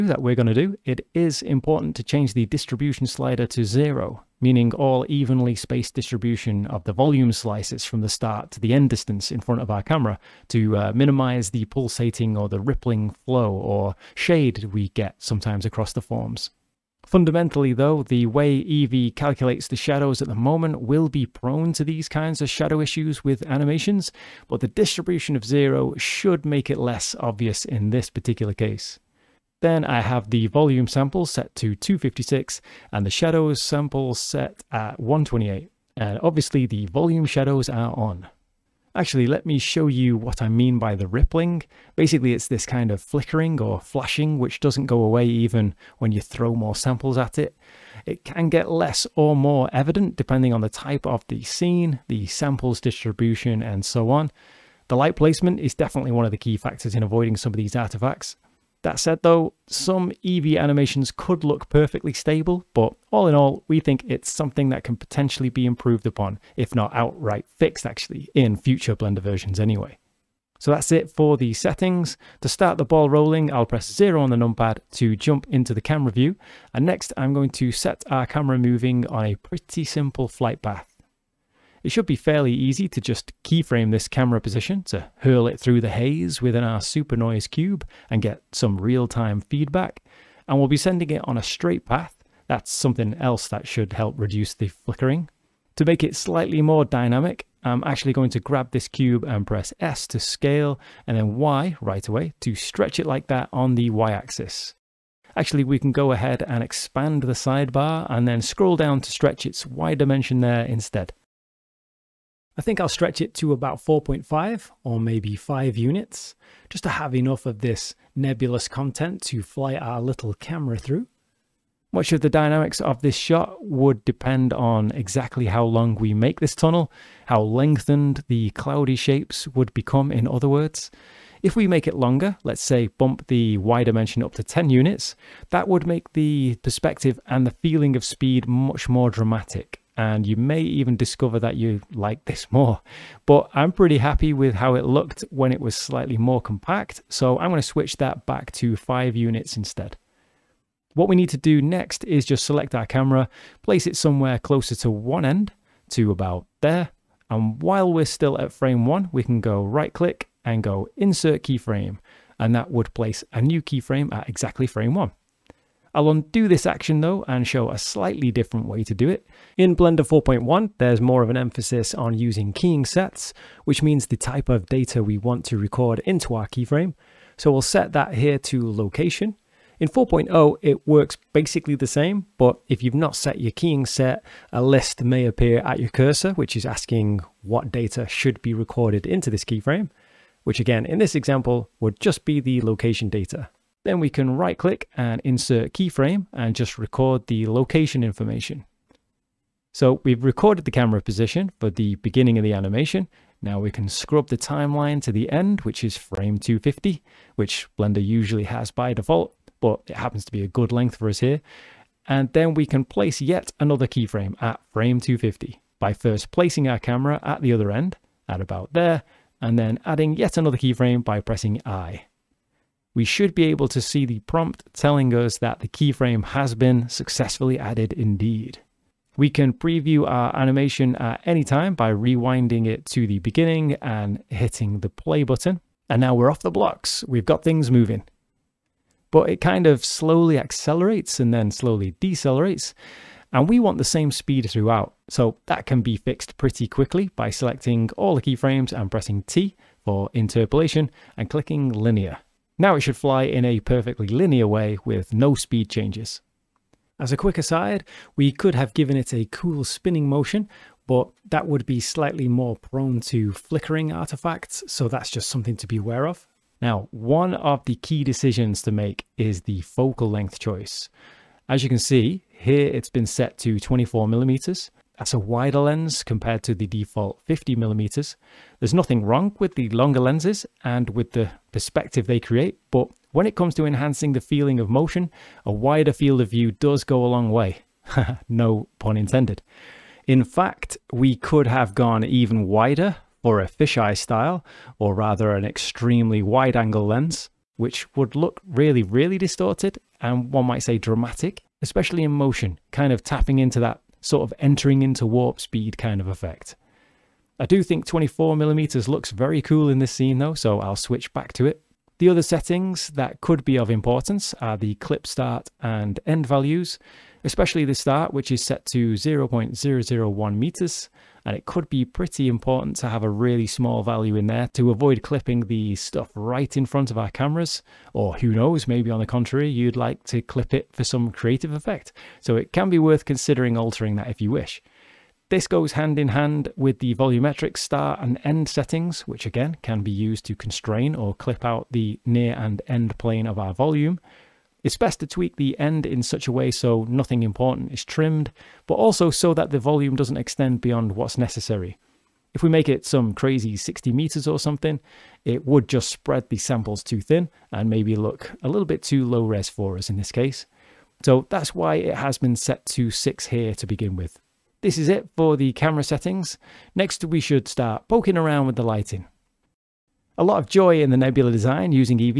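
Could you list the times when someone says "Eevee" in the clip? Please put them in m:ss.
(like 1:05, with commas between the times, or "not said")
0:18, 1:00.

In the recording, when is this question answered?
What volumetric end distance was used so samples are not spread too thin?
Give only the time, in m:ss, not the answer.
6:02.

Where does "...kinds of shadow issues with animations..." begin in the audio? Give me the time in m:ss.
0:22.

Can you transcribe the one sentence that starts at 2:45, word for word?
I'll undo this action though and show a slightly different way to do it.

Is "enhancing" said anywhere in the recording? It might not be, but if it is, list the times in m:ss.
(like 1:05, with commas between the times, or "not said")
4:43.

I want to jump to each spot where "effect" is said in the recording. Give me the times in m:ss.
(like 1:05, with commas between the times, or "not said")
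5:06, 5:31.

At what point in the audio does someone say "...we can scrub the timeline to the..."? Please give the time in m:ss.
3:23.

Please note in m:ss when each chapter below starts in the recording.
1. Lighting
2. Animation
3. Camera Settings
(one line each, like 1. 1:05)
1. 6:02
2. 1:09
3. 4:25.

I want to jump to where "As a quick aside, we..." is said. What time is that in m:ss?
4:16.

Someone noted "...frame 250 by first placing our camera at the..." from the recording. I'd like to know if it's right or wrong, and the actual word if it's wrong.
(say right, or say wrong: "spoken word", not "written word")
right.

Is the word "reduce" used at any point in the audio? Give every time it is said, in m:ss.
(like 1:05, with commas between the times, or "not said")
1:34.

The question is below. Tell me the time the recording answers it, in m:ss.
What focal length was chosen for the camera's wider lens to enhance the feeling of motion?
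4:33.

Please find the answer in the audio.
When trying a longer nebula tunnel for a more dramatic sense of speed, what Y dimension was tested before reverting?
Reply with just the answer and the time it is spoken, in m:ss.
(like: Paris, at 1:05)
10 units, at 2:14.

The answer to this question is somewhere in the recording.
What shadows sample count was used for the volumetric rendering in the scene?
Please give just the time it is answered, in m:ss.
0:34.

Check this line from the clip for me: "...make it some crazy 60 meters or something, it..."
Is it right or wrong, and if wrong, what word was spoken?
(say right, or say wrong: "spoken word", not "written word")
right.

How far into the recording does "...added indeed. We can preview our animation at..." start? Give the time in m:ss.
3:47.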